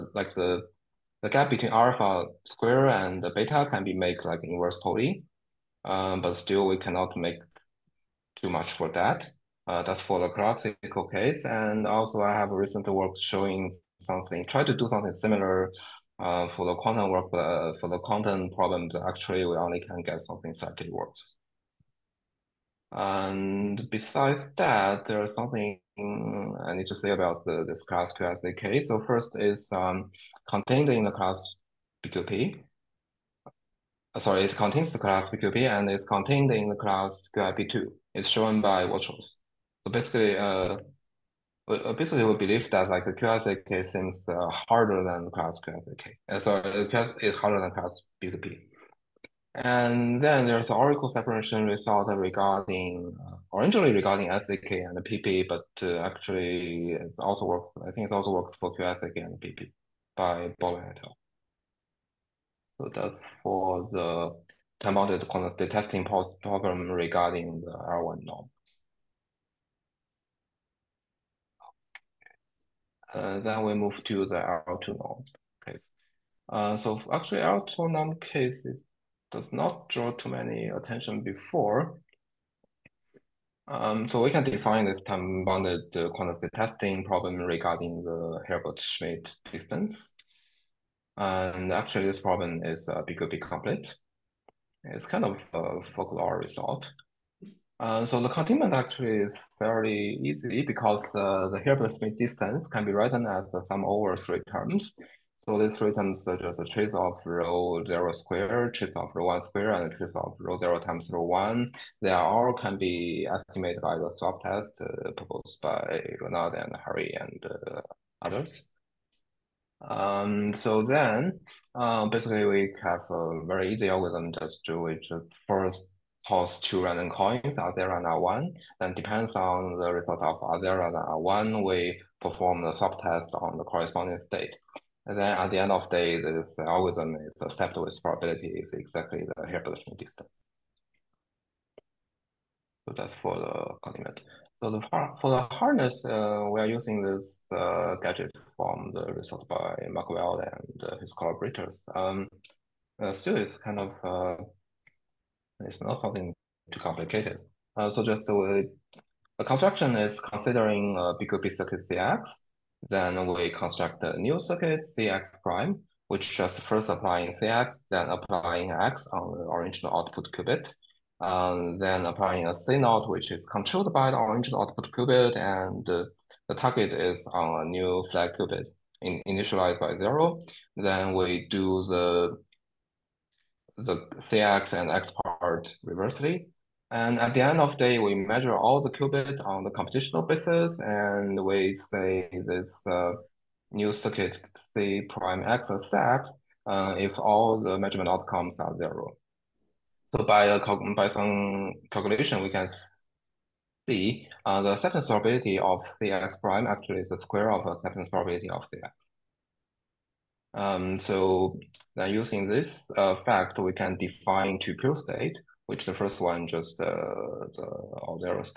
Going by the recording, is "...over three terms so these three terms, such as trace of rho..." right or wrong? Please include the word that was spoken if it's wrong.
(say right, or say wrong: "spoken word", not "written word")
right.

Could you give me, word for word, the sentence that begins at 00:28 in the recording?
So first is um, contained in the class BQP.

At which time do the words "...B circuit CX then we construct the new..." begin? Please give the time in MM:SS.
02:41.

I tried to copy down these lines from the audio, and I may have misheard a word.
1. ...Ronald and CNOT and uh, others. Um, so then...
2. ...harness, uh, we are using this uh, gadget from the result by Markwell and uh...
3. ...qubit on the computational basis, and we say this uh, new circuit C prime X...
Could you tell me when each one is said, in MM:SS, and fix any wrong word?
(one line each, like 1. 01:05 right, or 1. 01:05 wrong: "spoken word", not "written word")
1. 01:56 wrong: "Harry", not "CNOT"
2. 02:25 right
3. 03:08 right.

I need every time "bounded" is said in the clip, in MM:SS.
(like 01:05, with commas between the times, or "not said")
01:04, 01:25.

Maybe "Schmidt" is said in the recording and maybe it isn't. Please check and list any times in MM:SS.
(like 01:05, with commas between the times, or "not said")
01:28, 01:41.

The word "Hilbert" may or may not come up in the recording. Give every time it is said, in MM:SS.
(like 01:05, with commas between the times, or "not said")
01:28, 01:41, 02:19.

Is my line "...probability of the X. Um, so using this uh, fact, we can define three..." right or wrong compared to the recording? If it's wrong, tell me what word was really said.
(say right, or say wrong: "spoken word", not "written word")
wrong: "two", not "three".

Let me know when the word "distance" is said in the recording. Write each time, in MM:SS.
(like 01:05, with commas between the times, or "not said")
01:29, 01:42, 02:19.